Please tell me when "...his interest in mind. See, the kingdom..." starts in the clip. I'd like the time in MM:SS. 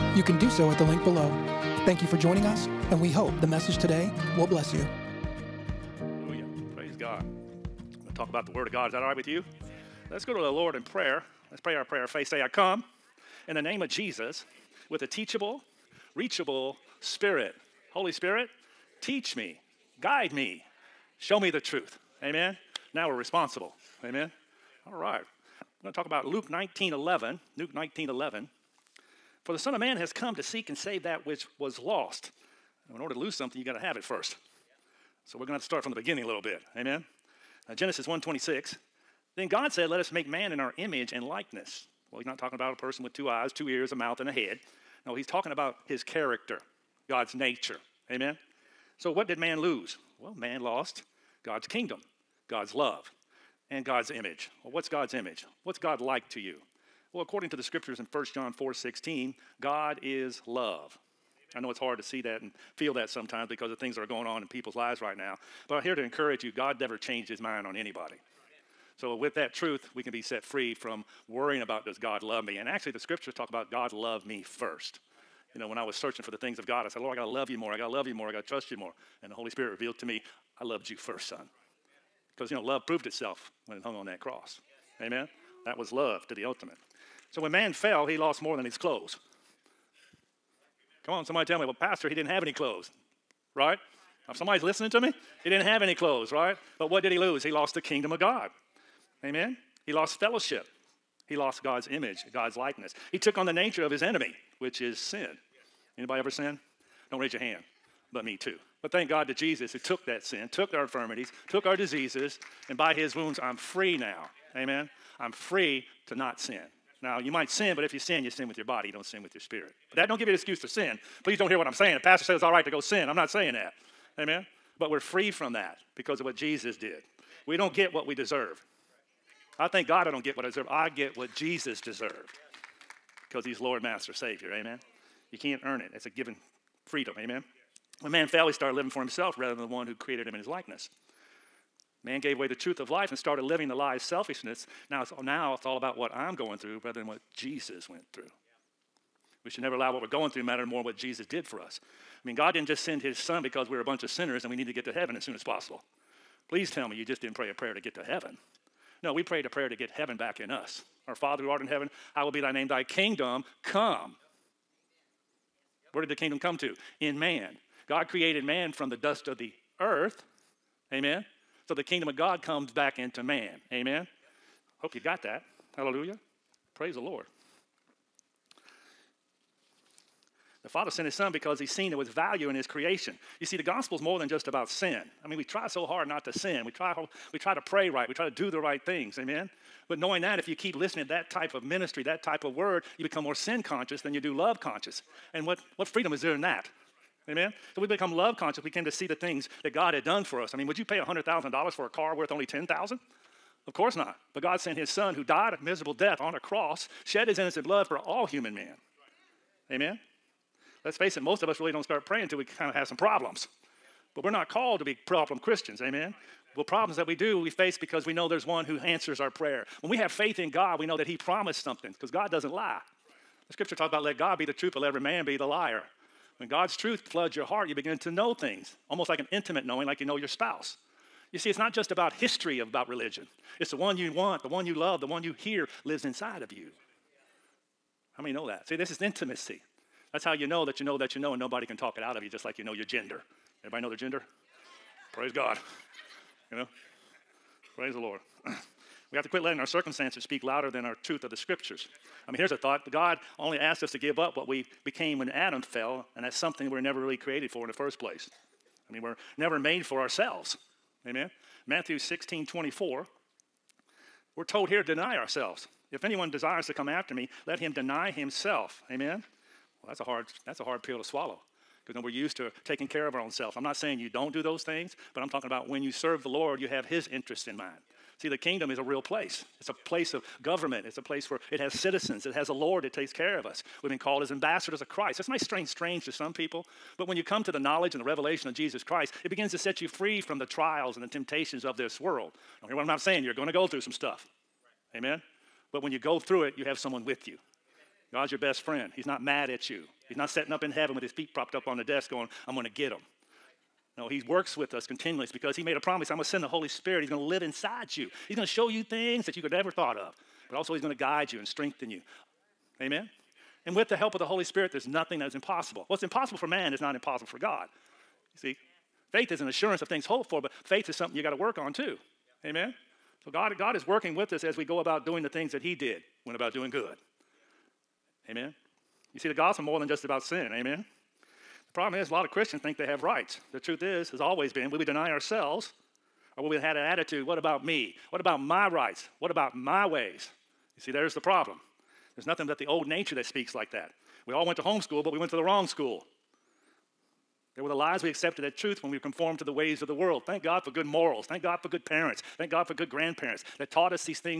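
04:36.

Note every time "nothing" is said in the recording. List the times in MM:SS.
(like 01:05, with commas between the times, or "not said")
05:14, 05:42.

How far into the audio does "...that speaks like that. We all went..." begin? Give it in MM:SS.
05:43.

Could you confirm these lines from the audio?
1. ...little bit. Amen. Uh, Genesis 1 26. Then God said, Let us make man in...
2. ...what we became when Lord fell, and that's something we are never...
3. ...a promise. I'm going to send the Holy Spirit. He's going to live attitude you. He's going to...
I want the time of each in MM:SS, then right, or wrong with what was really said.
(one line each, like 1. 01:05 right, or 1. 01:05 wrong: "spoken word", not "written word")
1. 00:36 right
2. 04:14 wrong: "Adam", not "Lord"
3. 05:05 wrong: "inside", not "attitude".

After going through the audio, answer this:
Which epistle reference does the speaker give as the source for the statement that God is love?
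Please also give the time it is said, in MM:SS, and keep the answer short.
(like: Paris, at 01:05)
1 John 4:16, at 00:58.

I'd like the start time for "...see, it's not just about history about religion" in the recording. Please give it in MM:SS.
03:51.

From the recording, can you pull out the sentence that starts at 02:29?
We should never allow what we're going through matter more than what Jesus did for us.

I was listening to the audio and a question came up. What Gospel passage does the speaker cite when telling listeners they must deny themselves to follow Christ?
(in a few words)
Matthew 16:24.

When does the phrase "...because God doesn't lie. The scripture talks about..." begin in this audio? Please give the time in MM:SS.
03:41.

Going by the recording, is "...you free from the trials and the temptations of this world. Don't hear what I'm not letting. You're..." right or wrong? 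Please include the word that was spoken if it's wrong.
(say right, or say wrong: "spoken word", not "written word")
wrong: "saying", not "letting".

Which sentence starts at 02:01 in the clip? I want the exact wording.
The pastor says it's all right to go sin.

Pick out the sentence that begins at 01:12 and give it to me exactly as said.
And actually, the scriptures talk about God loved me first.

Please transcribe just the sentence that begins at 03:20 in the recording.
I mean, would you pay $100,000 for a car worth only 10000 Of course not.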